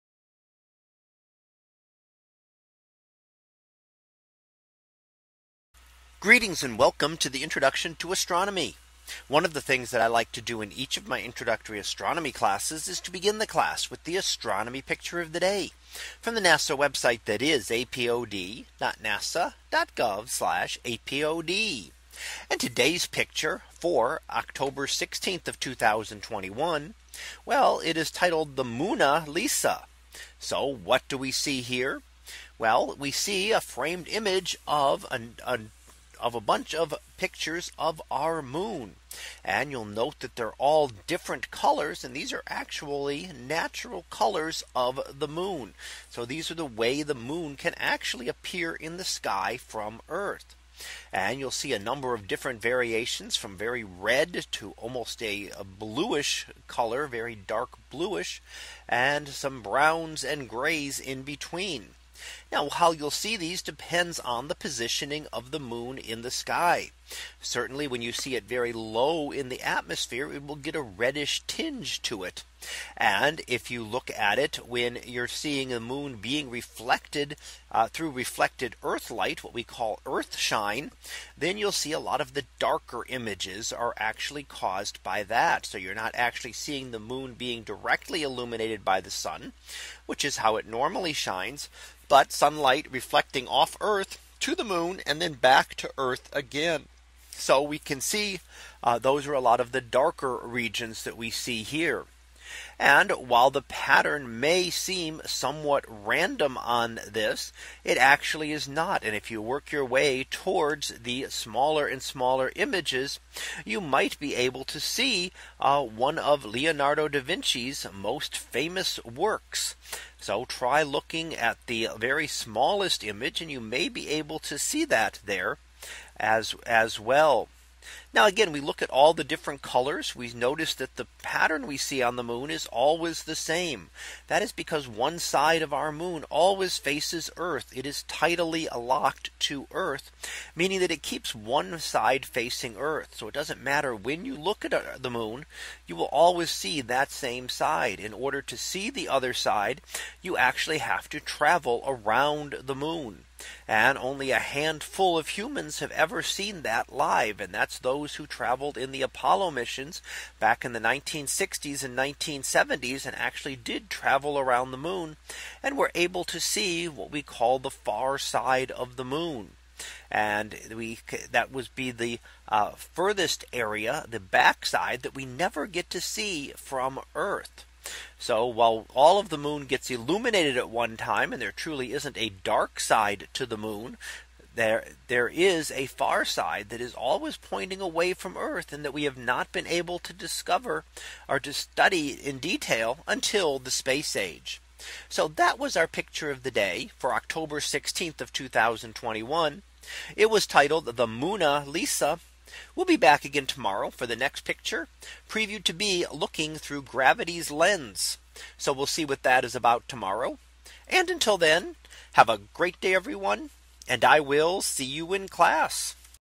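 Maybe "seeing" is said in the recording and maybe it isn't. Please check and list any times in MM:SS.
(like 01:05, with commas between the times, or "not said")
01:15, 01:26.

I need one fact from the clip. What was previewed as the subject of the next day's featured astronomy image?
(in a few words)
looking through gravity's lens.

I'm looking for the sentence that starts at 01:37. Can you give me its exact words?
So we can see uh, those are a lot of the darker regions that we see here.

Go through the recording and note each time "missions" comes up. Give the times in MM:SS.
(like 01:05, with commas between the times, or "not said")
02:39.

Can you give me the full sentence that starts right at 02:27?
In order to see the other side, you actually have to travel around the moon.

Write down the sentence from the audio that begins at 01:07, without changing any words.
Certainly when you see it very low in the atmosphere, it will get a reddish tinge to it.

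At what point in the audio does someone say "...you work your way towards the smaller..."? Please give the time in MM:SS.
01:49.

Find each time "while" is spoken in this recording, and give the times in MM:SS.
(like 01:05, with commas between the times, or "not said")
01:43, 02:58.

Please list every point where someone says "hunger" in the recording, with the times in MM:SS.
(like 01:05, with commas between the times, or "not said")
not said.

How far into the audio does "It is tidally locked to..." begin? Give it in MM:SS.
02:17.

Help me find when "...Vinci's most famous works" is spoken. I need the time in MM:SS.
01:57.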